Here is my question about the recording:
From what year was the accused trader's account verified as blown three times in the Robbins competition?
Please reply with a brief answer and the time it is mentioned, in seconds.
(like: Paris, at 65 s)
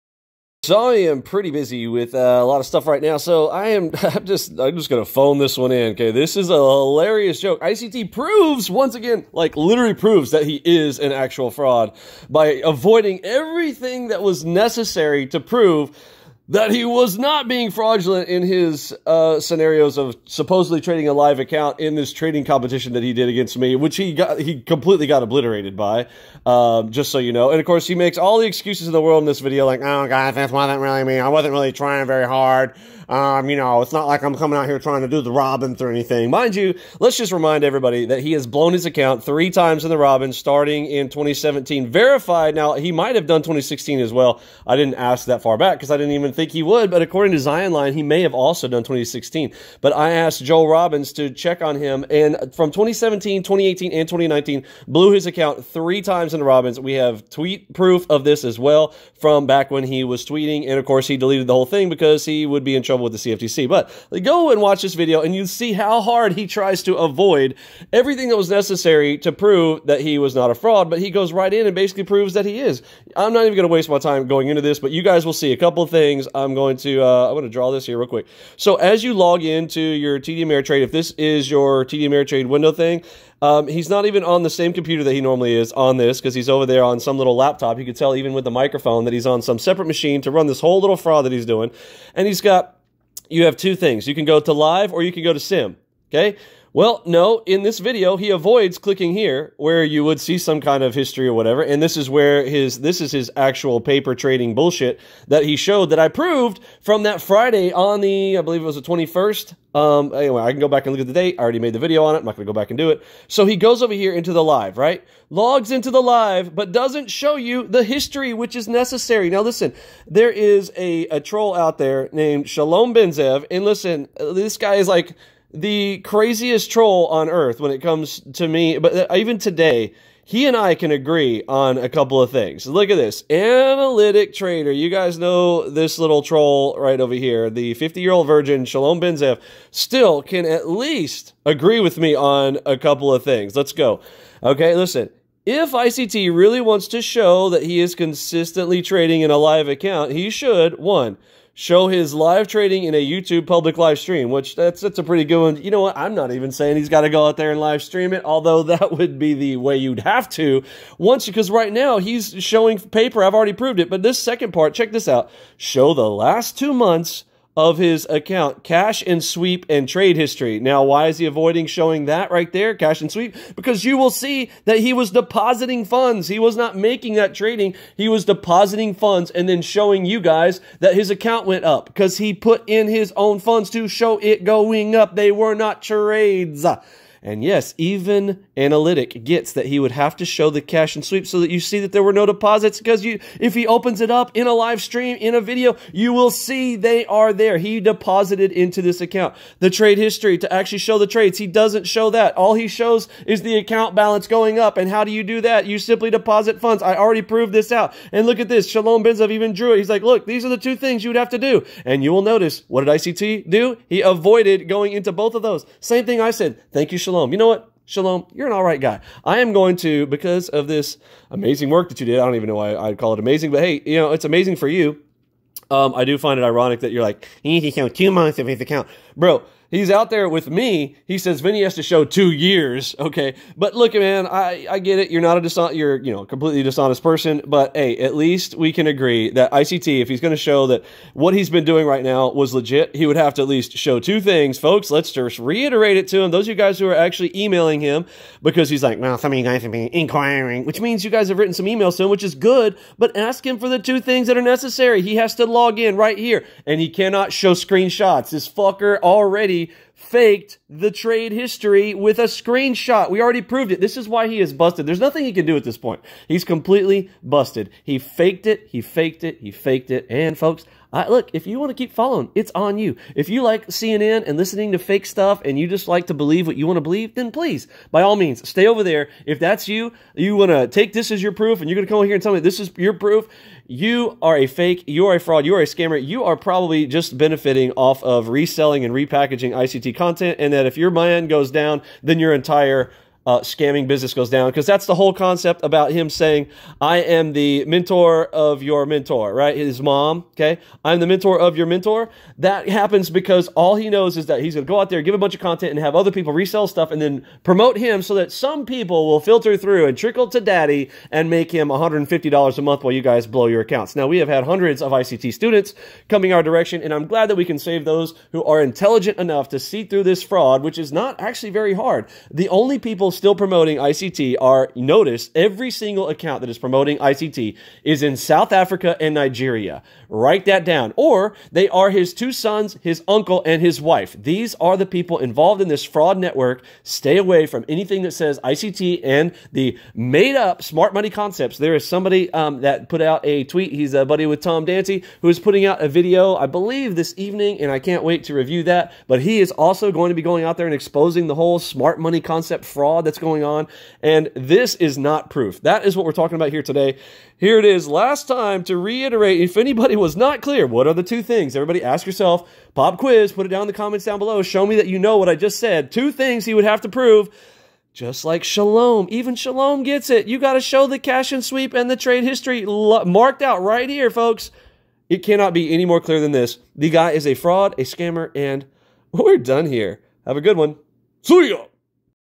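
2017, at 40 s.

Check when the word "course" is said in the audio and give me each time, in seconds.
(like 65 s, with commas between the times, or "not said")
27 s, 60 s.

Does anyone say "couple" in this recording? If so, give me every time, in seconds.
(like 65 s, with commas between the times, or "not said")
75 s, 131 s, 142 s.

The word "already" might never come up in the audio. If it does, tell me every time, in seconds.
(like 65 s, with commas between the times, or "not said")
111 s, 163 s, 206 s, 258 s, 263 s.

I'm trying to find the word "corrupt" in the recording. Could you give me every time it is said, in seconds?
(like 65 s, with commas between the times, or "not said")
not said.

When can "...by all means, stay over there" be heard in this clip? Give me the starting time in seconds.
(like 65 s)
277 s.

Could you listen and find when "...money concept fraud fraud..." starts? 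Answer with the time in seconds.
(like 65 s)
351 s.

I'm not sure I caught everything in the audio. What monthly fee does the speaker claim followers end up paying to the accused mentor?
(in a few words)
$150.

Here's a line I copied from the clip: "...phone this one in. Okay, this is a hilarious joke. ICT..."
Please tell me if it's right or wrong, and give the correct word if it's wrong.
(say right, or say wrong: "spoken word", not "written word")
right.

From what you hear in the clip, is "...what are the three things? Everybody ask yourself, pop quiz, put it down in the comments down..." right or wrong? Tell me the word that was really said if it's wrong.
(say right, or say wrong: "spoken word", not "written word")
wrong: "two", not "three".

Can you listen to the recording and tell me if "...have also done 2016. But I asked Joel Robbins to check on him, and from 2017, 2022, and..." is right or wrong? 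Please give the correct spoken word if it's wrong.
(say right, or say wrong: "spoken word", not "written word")
wrong: "2018", not "2022".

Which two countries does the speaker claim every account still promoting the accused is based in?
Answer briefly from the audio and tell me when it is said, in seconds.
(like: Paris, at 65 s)
South Africa and Nigeria, at 328 s.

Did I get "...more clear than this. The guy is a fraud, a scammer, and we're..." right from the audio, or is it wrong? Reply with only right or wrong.
right.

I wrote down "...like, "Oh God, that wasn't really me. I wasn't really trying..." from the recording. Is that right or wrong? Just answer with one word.
right.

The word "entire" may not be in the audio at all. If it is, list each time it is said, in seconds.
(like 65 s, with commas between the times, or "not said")
292 s.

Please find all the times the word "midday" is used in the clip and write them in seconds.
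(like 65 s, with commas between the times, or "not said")
not said.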